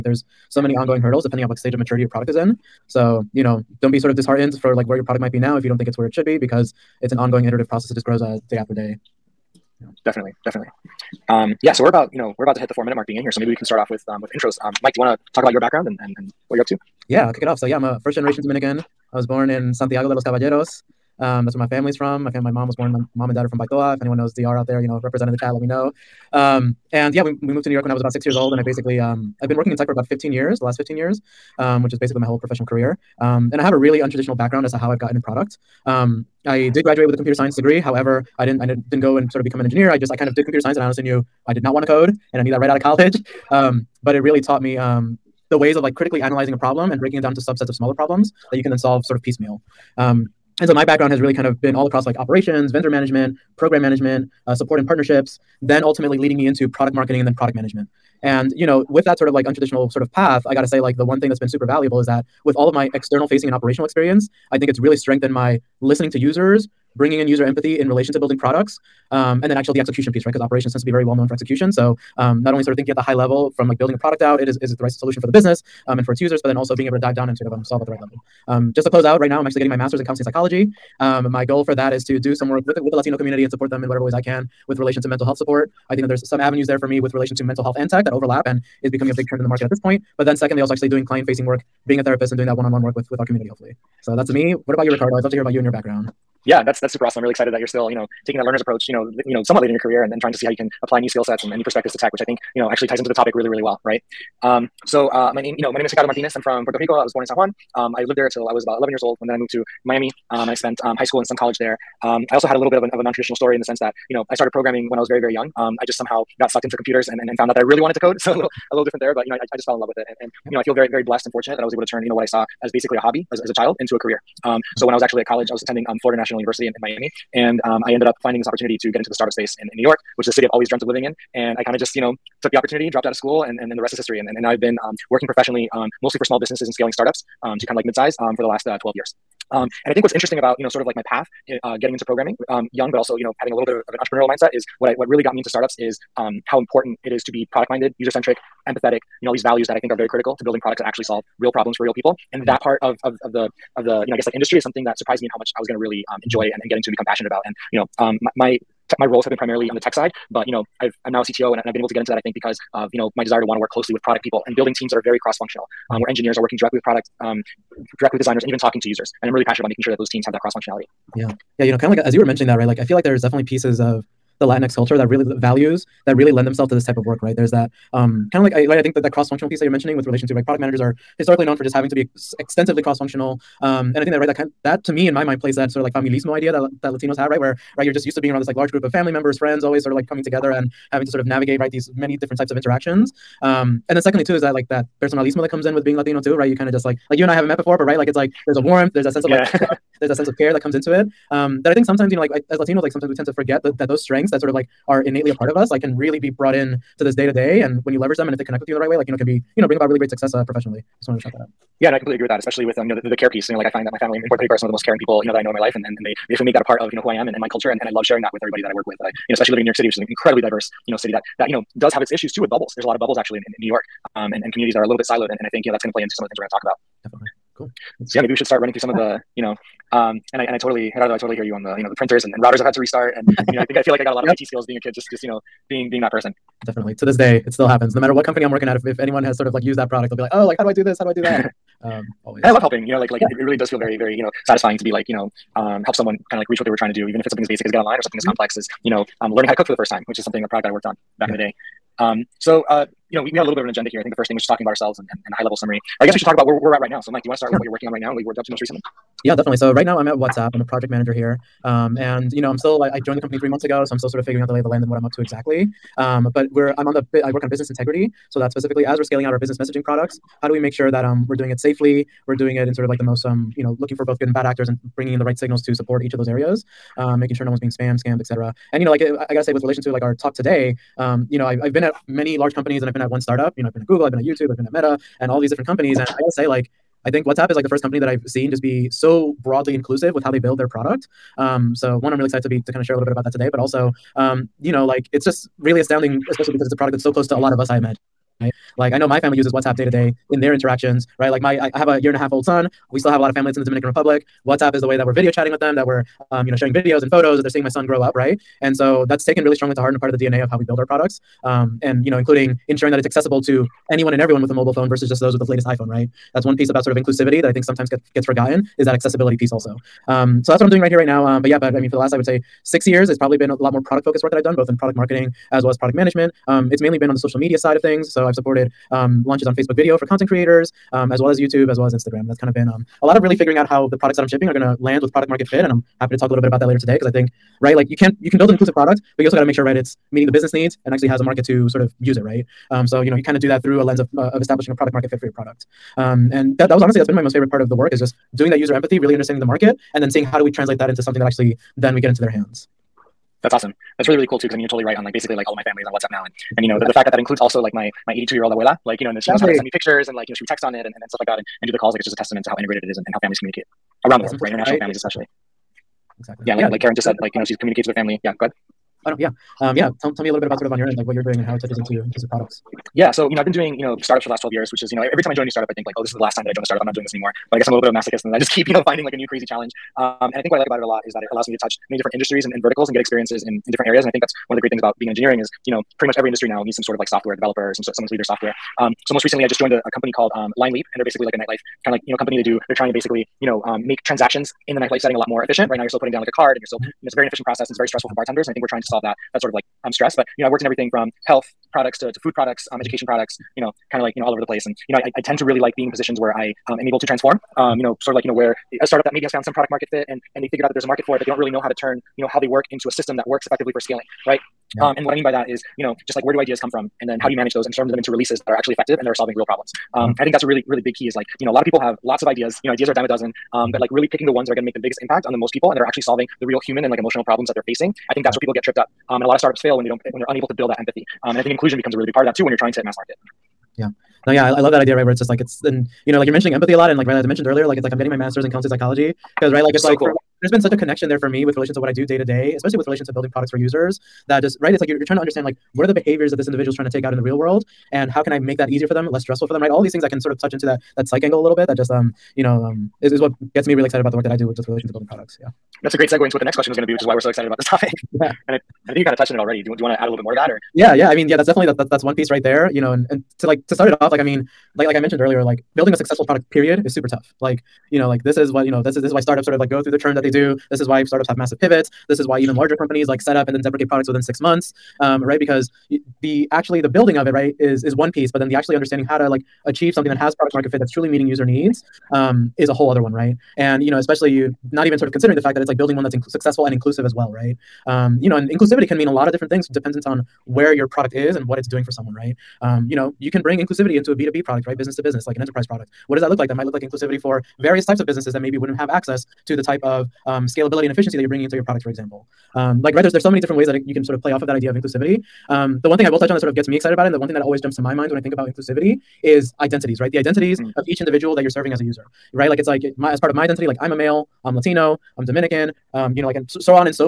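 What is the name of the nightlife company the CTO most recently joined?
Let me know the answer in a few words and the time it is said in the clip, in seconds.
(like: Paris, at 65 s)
LineLeap, at 390 s.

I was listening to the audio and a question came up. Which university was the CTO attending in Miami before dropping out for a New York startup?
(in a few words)
Florida National University.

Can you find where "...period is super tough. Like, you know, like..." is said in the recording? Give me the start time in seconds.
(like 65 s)
466 s.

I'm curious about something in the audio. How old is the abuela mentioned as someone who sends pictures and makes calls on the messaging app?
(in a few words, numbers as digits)
82.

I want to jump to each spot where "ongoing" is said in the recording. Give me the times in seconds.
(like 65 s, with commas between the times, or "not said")
0 s, 7 s.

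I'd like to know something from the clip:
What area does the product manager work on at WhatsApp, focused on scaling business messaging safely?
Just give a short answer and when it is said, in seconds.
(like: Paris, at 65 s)
Business integrity, at 267 s.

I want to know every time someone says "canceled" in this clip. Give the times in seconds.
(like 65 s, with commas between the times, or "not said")
not said.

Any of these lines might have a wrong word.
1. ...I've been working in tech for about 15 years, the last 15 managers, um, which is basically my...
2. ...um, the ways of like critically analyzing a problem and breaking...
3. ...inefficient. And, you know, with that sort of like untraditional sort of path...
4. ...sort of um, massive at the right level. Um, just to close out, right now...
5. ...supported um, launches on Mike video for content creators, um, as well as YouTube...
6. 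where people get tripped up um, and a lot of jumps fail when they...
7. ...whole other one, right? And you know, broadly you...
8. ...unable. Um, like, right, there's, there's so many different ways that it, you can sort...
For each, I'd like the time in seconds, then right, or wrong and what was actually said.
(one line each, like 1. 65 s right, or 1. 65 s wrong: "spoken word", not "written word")
1. 29 s wrong: "years", not "managers"
2. 44 s right
3. 57 s wrong: "management", not "inefficient"
4. 77 s wrong: "solve", not "massive"
5. 328 s wrong: "Facebook", not "Mike"
6. 428 s wrong: "startups", not "jumps"
7. 482 s wrong: "especially", not "broadly"
8. 501 s wrong: "example", not "unable".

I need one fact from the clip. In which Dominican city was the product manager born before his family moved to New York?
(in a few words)
Santiago de los Caballeros.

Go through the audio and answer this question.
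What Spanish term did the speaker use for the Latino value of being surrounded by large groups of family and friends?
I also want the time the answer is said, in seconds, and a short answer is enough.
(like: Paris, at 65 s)
familismo, at 185 s.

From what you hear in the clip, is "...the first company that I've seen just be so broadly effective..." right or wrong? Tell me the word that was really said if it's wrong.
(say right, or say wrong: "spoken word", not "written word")
wrong: "inclusive", not "effective".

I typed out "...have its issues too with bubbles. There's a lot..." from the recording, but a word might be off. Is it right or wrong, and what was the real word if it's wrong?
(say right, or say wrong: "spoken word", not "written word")
right.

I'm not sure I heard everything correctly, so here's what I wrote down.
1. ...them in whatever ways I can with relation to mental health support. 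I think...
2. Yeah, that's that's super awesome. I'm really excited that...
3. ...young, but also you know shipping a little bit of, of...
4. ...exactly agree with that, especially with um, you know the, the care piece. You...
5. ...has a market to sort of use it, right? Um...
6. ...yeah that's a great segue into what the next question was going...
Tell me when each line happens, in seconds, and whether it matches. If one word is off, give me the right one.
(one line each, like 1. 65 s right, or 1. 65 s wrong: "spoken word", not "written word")
1. 83 s right
2. 96 s right
3. 142 s wrong: "having", not "shipping"
4. 211 s wrong: "completely", not "exactly"
5. 341 s right
6. 455 s right.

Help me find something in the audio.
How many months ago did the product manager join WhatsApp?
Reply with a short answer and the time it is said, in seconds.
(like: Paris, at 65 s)
3, at 263 s.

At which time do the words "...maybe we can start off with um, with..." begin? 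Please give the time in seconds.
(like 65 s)
13 s.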